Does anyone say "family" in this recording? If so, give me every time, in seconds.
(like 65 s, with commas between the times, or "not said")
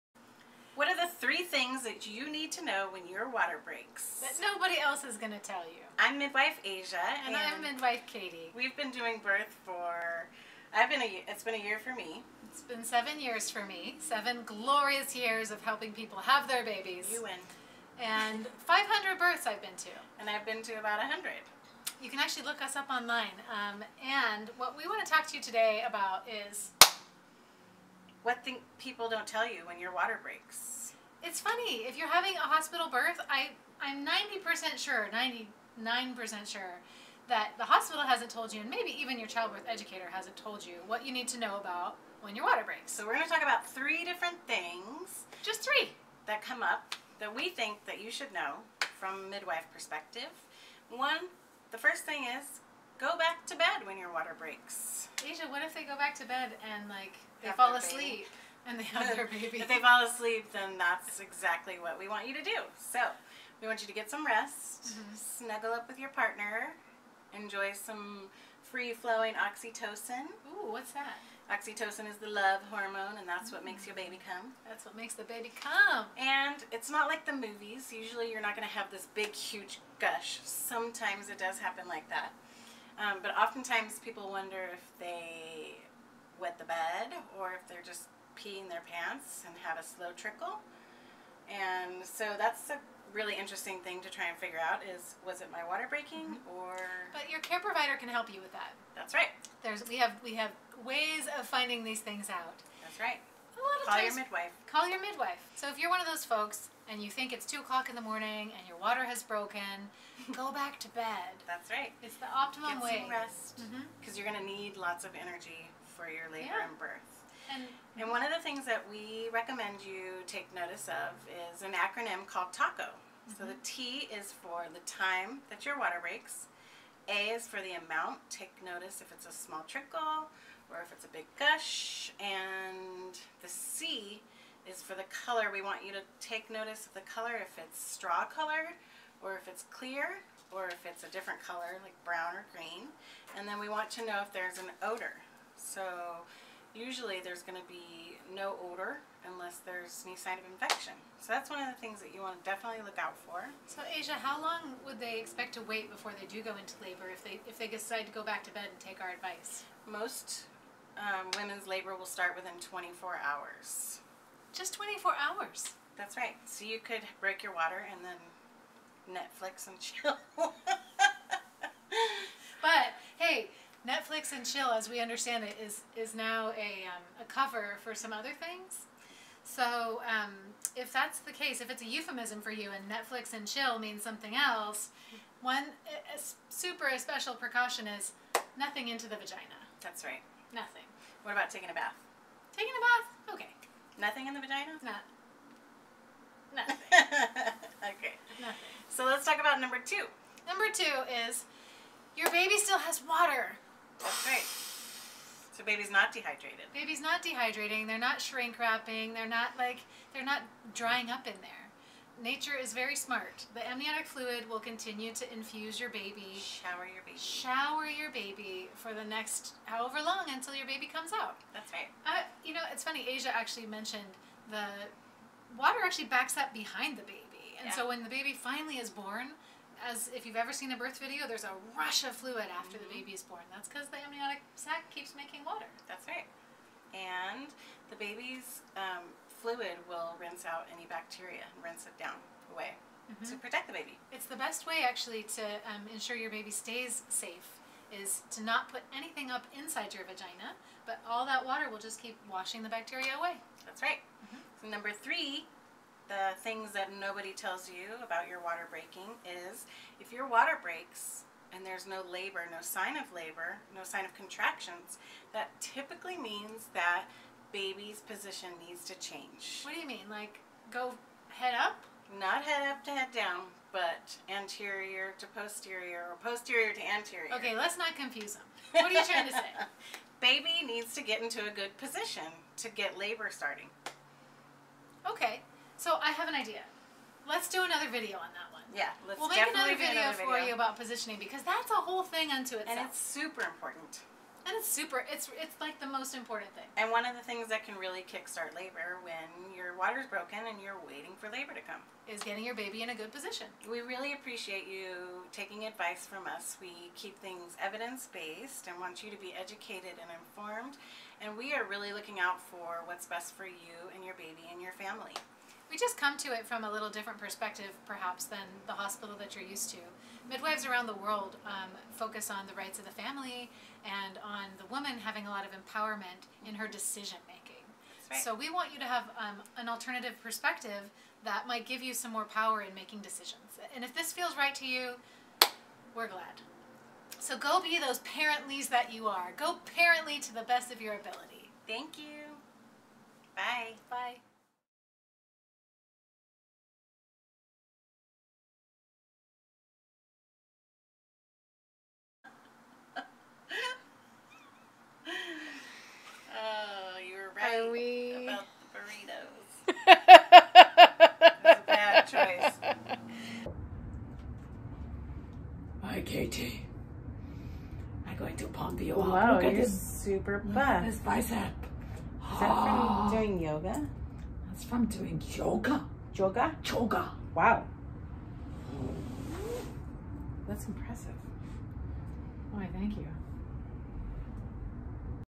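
314 s, 322 s.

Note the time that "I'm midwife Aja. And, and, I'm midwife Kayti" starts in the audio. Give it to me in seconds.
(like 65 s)
5 s.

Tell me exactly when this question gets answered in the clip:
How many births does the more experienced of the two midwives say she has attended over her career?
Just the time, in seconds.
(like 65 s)
18 s.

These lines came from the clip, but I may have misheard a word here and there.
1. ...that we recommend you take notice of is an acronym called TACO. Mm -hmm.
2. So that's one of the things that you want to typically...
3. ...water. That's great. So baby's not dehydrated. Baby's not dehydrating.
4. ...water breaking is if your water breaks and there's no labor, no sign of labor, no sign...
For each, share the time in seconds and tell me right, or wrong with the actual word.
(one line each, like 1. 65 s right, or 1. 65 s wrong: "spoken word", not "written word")
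1. 118 s right
2. 151 s wrong: "definitely", not "typically"
3. 203 s right
4. 258 s right.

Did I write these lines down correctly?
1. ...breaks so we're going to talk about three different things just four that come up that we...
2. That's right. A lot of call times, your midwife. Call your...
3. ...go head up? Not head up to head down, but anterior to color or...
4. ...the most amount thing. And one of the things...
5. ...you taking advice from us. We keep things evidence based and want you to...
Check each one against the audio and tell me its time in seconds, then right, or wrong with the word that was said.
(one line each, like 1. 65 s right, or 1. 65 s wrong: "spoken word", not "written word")
1. 42 s wrong: "three", not "four"
2. 102 s right
3. 270 s wrong: "posterior", not "color"
4. 295 s wrong: "important", not "amount"
5. 304 s right.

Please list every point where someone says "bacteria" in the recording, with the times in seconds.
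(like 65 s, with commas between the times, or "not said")
240 s, 252 s.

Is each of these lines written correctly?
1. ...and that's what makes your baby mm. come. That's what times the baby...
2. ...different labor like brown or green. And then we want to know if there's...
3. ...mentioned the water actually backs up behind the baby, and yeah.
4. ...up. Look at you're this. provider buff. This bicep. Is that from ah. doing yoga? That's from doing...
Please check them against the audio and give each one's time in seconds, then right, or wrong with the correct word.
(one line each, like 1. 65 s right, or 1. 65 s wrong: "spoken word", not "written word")
1. 73 s wrong: "makes", not "times"
2. 141 s wrong: "color", not "labor"
3. 223 s right
4. 368 s wrong: "super", not "provider".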